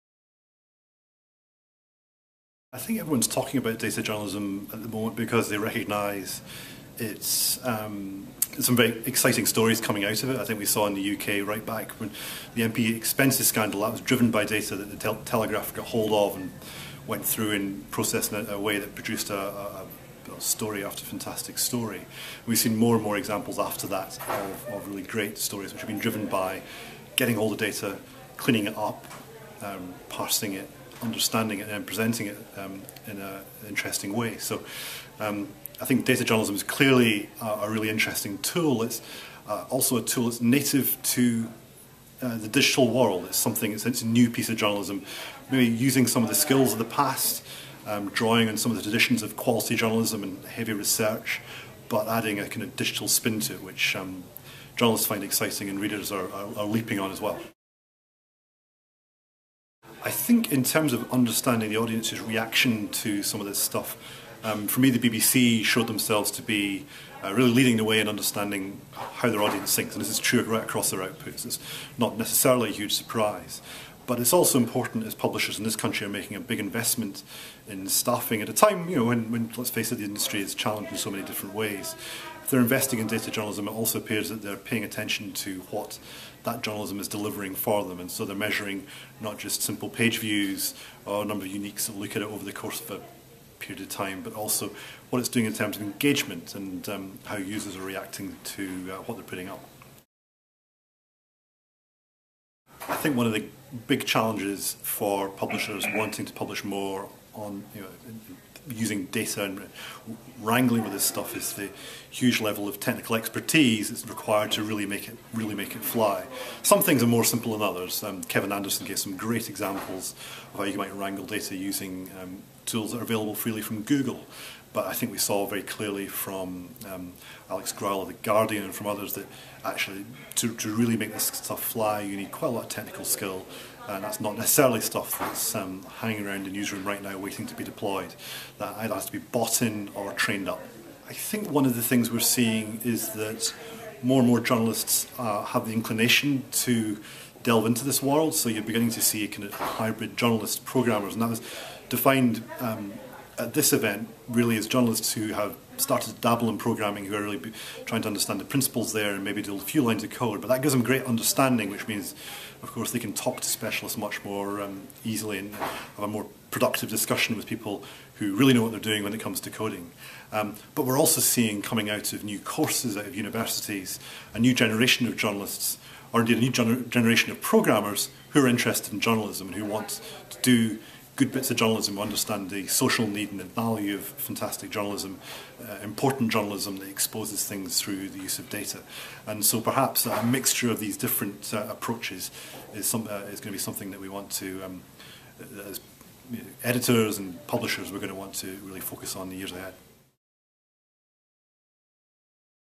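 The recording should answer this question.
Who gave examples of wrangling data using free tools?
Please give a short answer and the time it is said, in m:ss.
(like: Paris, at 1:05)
Kevin Anderson, at 1:58.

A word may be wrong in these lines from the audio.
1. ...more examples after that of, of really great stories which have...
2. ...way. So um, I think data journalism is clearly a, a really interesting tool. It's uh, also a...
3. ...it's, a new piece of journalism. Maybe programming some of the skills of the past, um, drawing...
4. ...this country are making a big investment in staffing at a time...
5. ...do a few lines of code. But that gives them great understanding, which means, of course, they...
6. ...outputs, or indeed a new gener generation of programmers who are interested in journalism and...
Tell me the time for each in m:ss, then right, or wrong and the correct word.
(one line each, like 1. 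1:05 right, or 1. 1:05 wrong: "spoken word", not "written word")
1. 0:23 right
2. 0:34 right
3. 0:43 wrong: "using", not "programming"
4. 1:15 right
5. 2:39 right
6. 2:55 wrong: "journalists", not "outputs".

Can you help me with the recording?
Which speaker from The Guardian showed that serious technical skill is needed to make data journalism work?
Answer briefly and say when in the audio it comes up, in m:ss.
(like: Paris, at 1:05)
Alex Graul, at 2:07.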